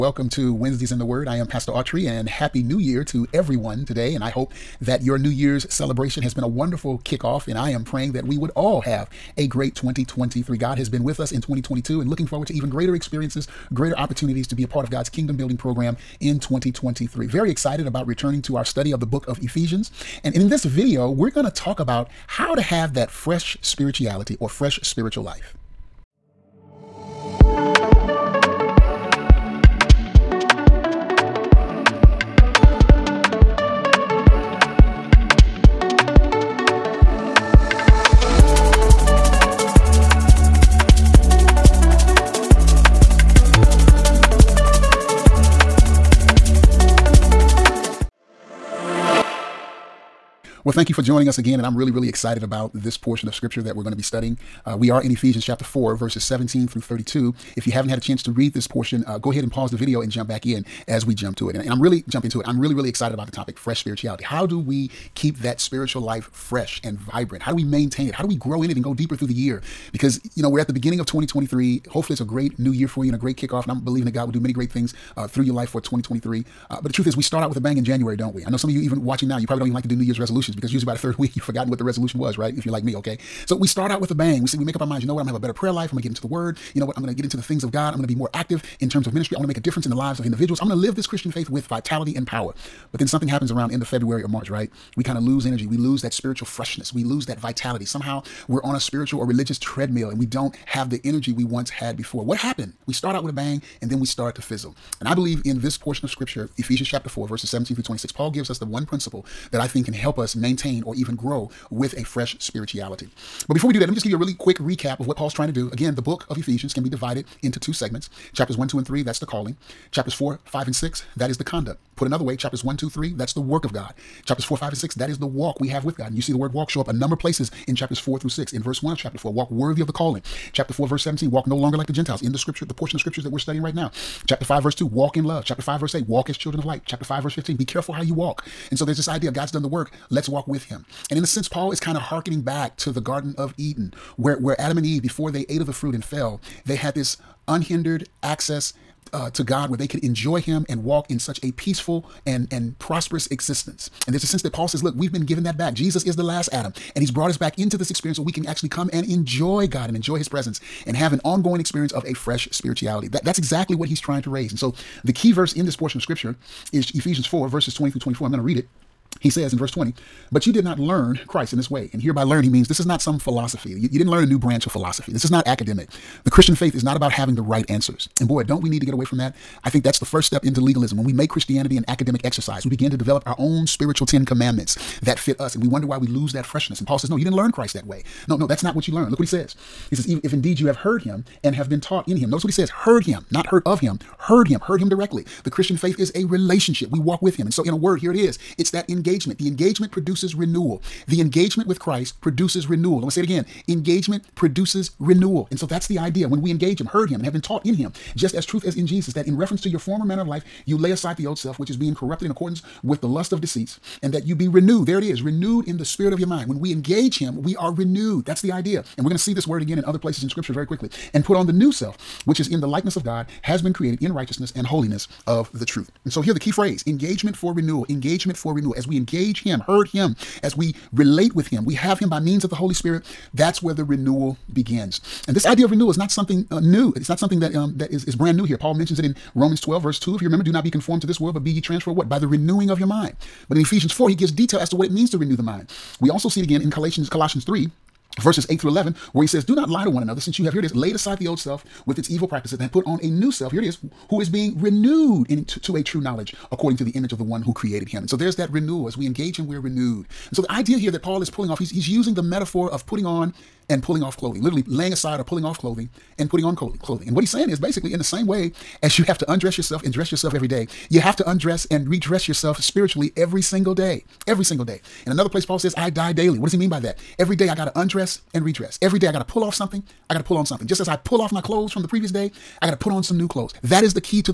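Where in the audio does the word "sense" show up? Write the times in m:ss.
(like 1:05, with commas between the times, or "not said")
2:21, 2:34.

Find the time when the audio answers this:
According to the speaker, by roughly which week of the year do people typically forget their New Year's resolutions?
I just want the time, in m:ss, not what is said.
1:20.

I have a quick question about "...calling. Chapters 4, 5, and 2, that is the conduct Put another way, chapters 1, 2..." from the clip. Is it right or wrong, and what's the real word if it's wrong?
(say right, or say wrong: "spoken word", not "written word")
wrong: "6", not "2".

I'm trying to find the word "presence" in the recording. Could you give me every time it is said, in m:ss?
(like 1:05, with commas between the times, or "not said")
2:40.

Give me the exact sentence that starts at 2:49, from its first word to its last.
He says in verse 20, but you did not learn Christ in this way.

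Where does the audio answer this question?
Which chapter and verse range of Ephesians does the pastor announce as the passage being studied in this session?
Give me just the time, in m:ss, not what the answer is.
0:55.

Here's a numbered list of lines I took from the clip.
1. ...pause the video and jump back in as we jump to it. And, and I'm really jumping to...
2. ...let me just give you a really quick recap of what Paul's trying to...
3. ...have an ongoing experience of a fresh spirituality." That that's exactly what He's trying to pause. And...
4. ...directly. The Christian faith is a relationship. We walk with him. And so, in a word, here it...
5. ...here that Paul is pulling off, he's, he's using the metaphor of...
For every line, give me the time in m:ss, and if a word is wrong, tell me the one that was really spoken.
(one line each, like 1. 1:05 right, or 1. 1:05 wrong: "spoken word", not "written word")
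1. 0:59 right
2. 1:53 right
3. 2:40 wrong: "raise", not "pause"
4. 3:14 right
5. 4:20 right.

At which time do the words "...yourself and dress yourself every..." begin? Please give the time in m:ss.
4:29.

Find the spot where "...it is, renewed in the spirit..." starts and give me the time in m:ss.
3:34.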